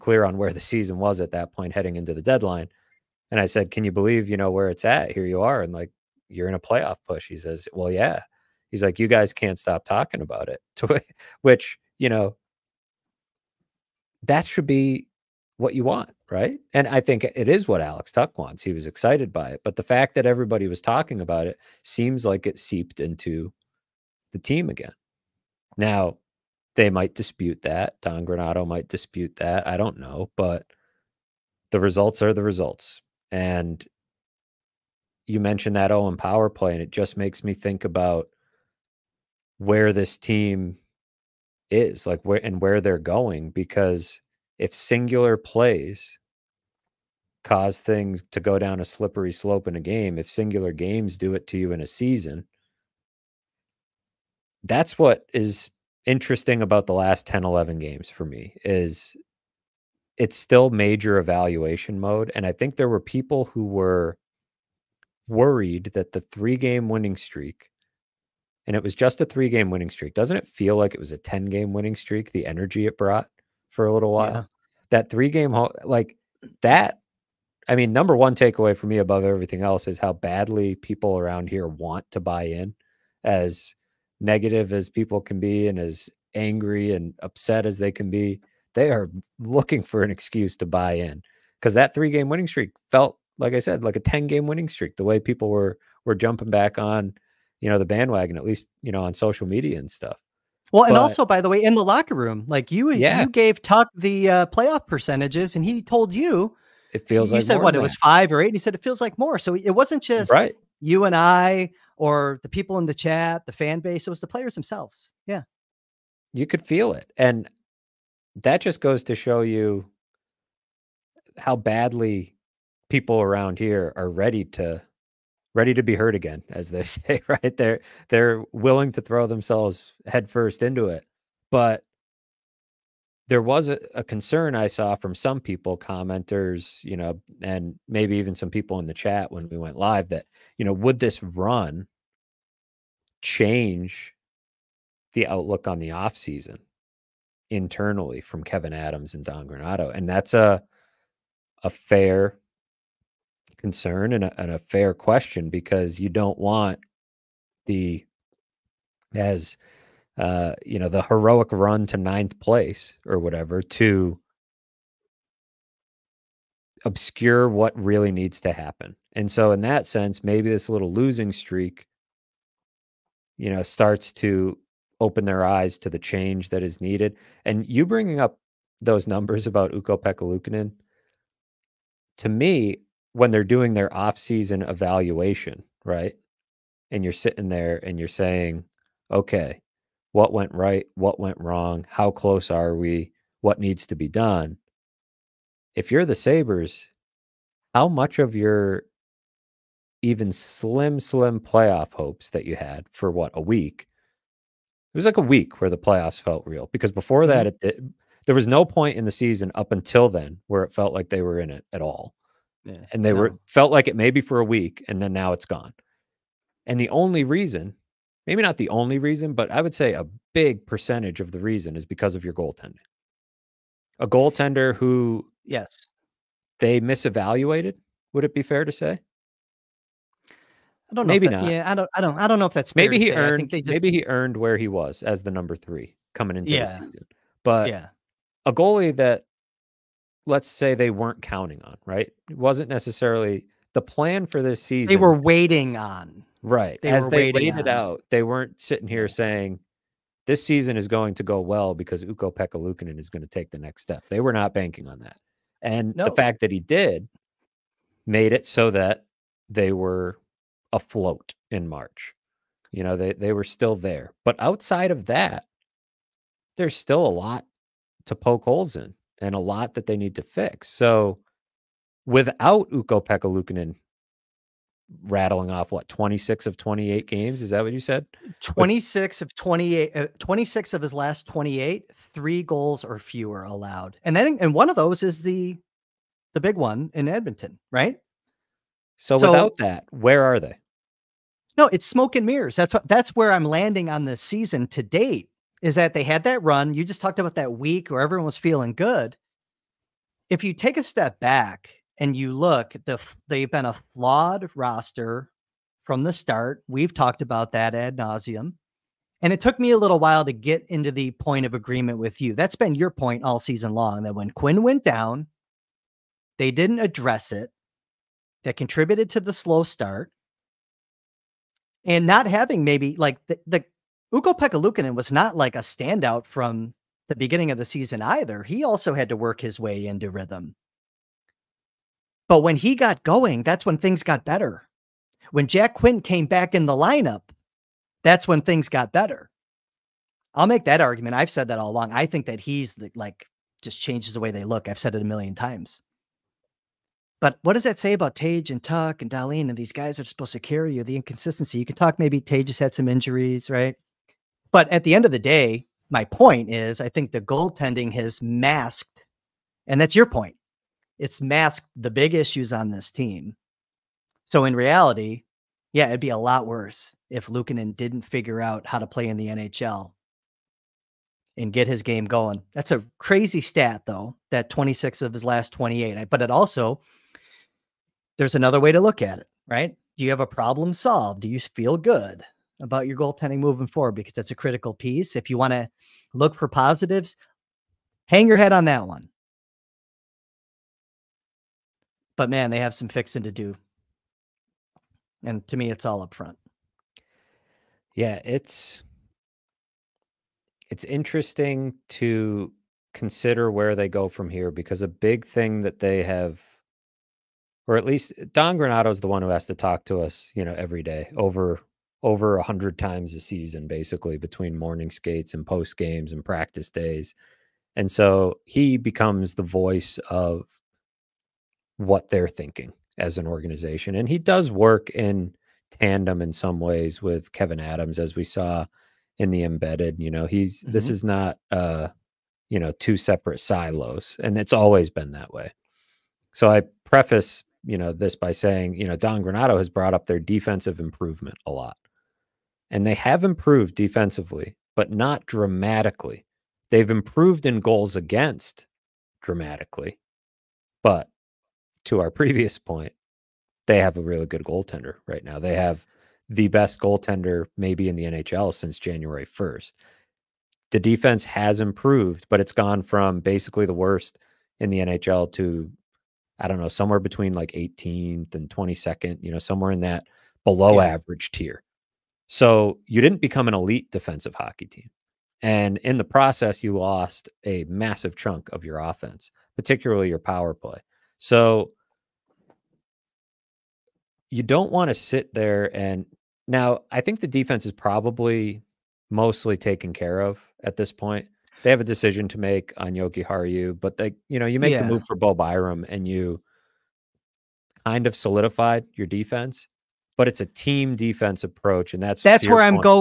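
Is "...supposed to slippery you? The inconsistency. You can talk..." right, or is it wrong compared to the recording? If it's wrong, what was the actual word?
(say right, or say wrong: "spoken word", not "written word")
wrong: "carry", not "slippery".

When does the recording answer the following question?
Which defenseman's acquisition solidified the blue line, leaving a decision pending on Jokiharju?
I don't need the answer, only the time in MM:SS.
08:15.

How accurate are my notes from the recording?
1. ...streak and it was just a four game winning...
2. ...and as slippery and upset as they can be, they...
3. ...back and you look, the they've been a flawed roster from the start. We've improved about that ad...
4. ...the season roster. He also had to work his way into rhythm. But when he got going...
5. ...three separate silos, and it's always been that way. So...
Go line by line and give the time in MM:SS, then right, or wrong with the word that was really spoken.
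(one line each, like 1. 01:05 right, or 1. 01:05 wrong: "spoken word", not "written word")
1. 01:07 wrong: "three", not "four"
2. 01:25 wrong: "angry", not "slippery"
3. 05:01 wrong: "talked", not "improved"
4. 05:27 wrong: "either", not "roster"
5. 07:12 wrong: "two", not "three".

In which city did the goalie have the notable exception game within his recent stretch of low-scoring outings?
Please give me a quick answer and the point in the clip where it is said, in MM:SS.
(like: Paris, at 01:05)
Edmonton, at 04:47.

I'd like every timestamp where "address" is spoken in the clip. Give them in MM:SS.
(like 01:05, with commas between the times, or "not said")
05:16.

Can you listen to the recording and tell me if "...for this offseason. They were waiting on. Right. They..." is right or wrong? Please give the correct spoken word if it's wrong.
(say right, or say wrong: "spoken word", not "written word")
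wrong: "season", not "offseason".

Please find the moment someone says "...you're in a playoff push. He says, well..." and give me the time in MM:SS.
00:06.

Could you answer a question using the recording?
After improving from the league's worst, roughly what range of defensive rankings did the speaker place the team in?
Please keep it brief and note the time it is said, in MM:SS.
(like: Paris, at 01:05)
18th to 22nd, at 07:47.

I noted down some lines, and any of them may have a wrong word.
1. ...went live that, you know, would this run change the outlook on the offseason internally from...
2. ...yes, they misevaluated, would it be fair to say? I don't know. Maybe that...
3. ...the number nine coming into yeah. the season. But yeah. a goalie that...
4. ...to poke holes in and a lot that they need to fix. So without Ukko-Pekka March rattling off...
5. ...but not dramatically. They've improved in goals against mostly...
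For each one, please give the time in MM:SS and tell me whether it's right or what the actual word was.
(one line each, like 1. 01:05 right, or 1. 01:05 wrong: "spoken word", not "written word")
1. 02:19 right
2. 03:45 right
3. 03:55 wrong: "three", not "nine"
4. 04:28 wrong: "Luukkonen", not "March"
5. 07:24 wrong: "dramatically", not "mostly".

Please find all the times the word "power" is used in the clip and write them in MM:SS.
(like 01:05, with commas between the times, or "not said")
00:36, 08:00.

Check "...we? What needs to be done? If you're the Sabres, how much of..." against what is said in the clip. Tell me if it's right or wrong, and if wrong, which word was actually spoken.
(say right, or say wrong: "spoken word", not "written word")
right.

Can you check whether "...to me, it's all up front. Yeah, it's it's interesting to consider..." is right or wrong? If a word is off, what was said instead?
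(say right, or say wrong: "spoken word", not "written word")
right.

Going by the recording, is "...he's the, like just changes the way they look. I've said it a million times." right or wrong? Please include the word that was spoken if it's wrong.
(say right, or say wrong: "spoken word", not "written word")
right.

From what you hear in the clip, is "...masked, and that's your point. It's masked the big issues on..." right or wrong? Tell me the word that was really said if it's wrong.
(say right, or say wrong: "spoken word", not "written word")
right.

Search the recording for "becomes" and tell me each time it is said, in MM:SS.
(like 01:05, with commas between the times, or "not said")
06:58, 07:53.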